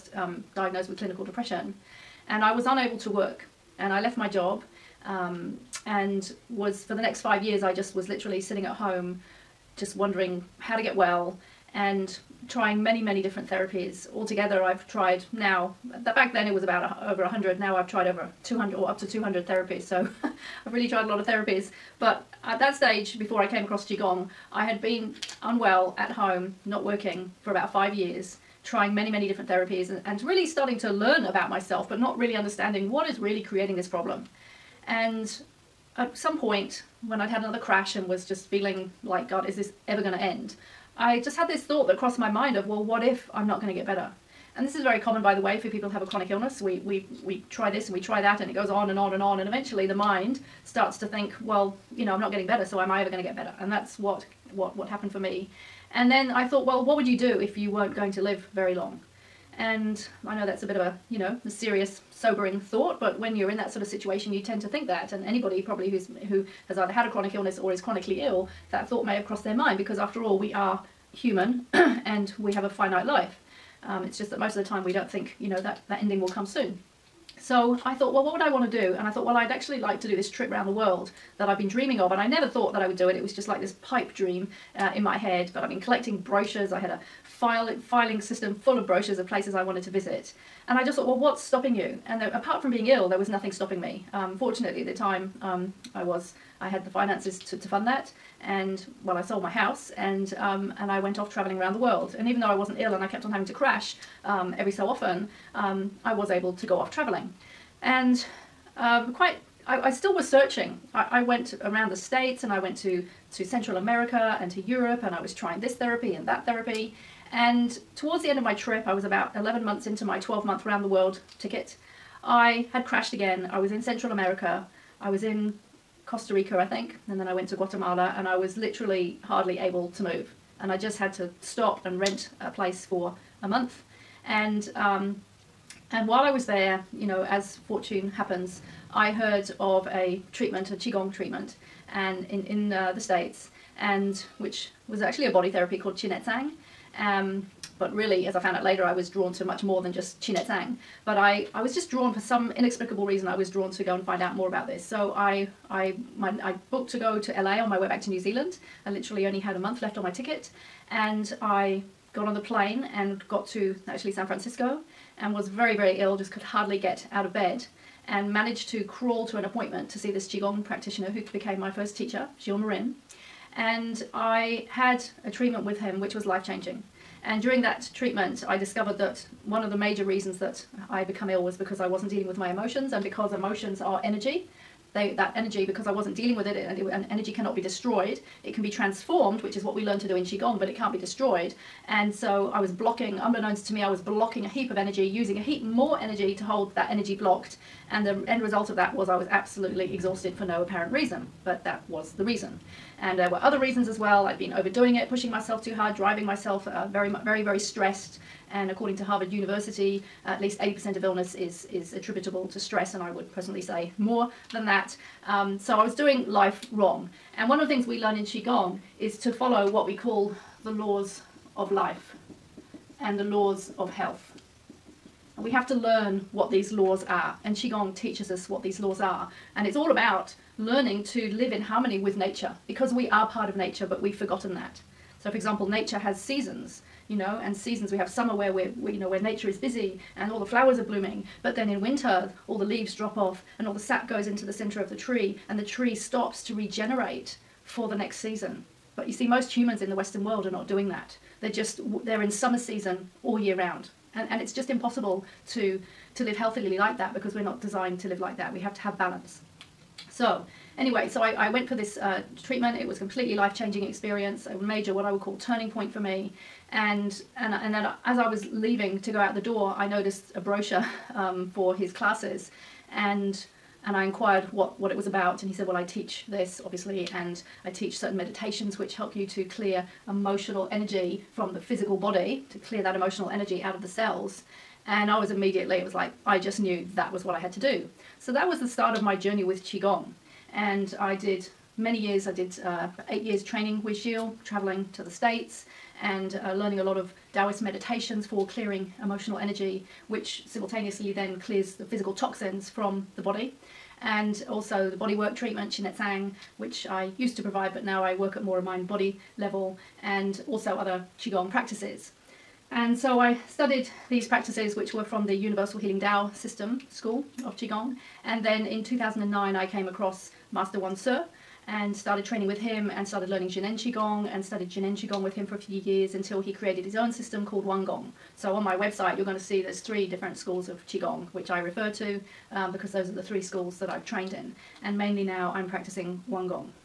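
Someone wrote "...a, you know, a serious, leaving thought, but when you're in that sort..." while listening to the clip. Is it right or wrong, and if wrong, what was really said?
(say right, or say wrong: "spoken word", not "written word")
wrong: "sobering", not "leaving".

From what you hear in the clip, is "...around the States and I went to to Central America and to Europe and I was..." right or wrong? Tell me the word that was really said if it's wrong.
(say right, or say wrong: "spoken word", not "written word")
right.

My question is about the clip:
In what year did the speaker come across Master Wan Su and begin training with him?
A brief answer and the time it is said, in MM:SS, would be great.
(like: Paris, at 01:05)
2009, at 05:18.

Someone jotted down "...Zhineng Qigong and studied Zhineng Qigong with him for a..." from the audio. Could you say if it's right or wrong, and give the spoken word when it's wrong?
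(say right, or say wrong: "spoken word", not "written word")
right.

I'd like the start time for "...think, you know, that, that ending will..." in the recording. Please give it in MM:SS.
01:15.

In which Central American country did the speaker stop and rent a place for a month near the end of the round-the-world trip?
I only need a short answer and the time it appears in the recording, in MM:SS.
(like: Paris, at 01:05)
Guatemala, at 02:07.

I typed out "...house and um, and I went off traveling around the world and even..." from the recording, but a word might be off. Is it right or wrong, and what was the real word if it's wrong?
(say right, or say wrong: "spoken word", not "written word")
right.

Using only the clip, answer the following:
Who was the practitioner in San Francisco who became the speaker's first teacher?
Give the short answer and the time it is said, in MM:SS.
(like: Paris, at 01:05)
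Gilles Marin, at 02:52.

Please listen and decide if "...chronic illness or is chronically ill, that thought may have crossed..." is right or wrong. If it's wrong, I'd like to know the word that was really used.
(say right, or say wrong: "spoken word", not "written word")
right.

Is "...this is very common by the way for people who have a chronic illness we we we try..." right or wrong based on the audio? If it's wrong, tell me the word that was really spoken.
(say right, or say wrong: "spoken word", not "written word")
right.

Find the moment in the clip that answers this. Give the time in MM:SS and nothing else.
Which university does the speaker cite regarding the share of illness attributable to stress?
03:29.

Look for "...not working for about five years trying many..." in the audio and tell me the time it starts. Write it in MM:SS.
00:26.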